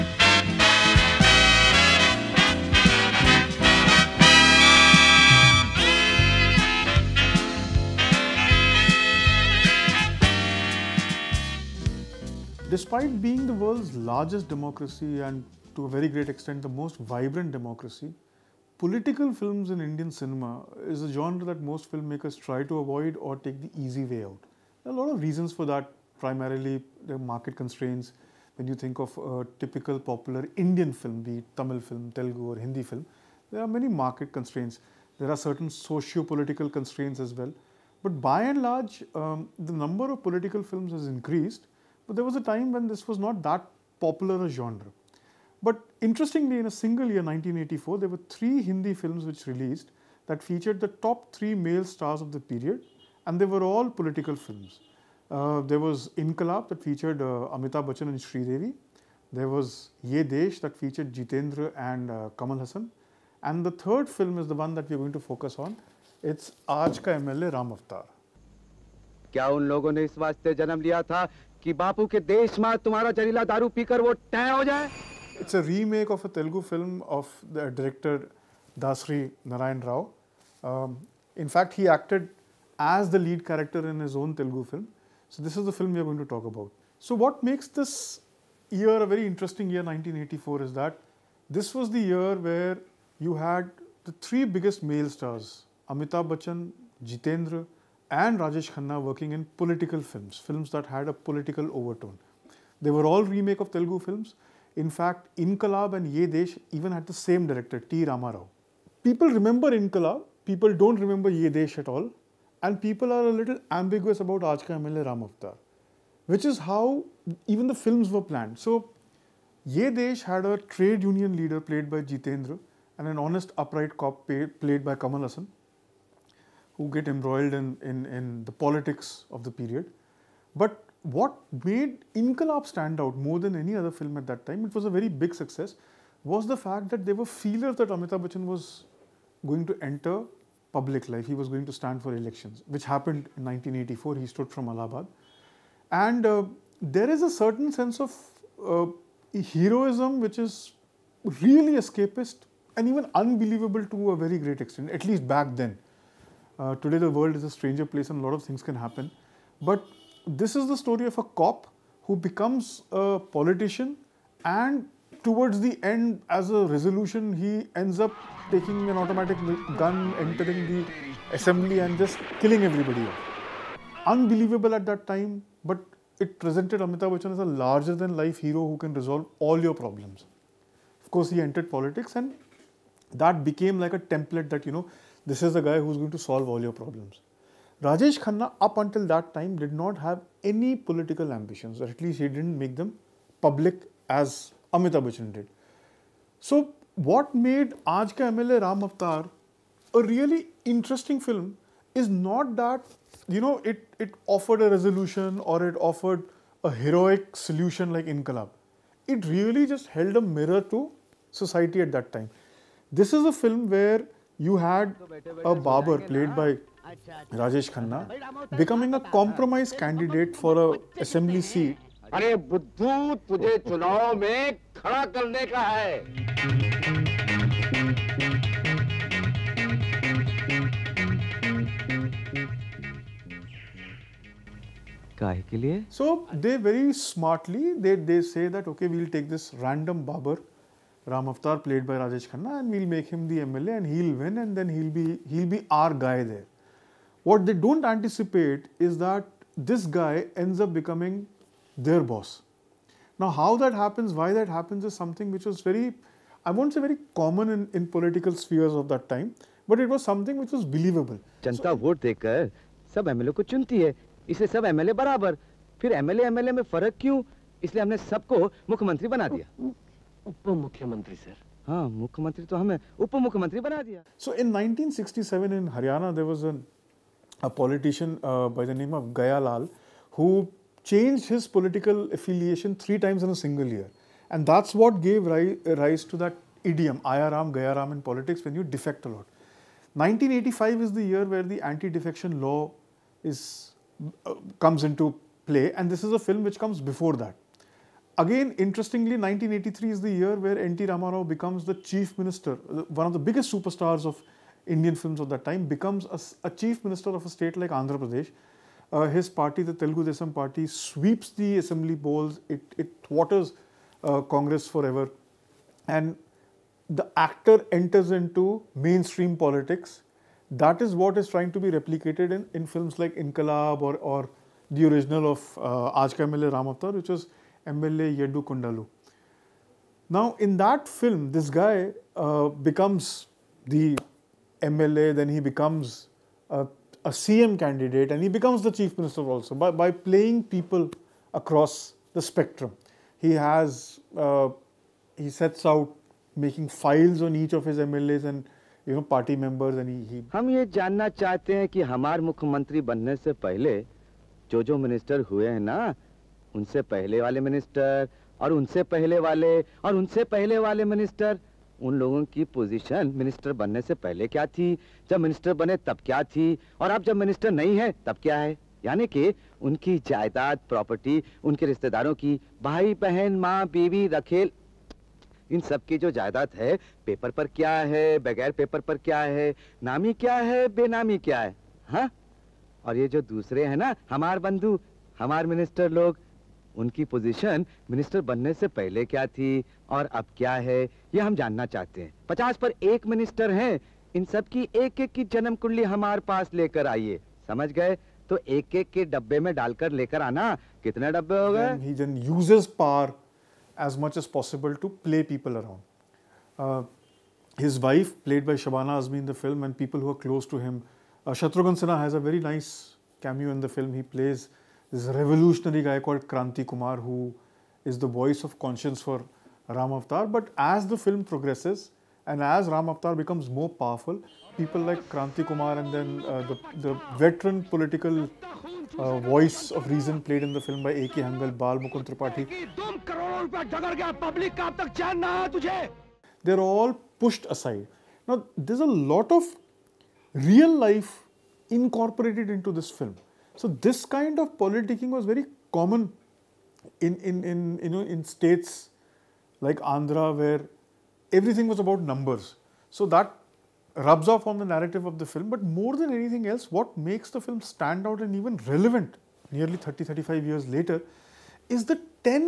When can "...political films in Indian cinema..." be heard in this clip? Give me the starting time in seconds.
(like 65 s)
18 s.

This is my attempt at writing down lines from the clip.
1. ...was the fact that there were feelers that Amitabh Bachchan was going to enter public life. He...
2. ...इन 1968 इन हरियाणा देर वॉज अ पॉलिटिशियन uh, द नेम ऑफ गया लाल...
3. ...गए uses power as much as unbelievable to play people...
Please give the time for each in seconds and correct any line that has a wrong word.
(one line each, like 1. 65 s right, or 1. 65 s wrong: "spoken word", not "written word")
1. 136 s right
2. 274 s wrong: "1967", not "1968"
3. 401 s wrong: "possible", not "unbelievable".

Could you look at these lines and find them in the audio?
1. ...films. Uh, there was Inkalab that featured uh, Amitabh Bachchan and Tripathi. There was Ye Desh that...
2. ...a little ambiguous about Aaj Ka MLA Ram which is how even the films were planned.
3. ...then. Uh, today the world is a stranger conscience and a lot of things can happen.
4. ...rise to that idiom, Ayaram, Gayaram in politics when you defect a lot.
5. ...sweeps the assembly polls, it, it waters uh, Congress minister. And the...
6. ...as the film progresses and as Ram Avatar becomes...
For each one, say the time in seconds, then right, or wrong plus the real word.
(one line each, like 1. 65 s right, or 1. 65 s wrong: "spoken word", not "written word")
1. 54 s wrong: "Sridevi", not "Tripathi"
2. 113 s right
3. 155 s wrong: "place", not "conscience"
4. 285 s right
5. 310 s wrong: "forever", not "minister"
6. 420 s right.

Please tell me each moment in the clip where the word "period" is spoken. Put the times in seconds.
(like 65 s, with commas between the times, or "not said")
52 s, 129 s.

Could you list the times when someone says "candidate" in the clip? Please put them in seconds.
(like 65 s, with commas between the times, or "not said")
219 s, 337 s.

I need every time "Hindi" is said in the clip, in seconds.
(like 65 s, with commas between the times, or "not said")
32 s, 48 s.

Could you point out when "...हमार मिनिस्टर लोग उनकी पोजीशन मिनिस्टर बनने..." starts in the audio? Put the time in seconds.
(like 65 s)
385 s.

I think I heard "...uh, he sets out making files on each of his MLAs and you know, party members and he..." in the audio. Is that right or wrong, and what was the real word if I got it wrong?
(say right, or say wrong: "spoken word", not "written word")
right.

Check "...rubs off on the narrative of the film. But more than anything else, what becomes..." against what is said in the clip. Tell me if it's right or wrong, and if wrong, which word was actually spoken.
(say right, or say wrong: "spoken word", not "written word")
wrong: "makes", not "becomes".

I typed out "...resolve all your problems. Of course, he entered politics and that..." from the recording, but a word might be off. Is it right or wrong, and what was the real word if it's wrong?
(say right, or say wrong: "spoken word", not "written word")
right.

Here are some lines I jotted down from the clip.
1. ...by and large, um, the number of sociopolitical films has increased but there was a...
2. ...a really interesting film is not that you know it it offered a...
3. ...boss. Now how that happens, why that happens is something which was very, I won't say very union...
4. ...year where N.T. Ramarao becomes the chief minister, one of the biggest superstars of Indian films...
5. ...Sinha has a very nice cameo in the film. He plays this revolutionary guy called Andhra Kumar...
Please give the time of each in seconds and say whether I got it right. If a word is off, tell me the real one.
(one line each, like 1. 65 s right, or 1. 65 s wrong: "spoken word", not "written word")
1. 38 s wrong: "political", not "sociopolitical"
2. 199 s right
3. 252 s wrong: "common", not "union"
4. 300 s right
5. 411 s wrong: "Kranti", not "Andhra".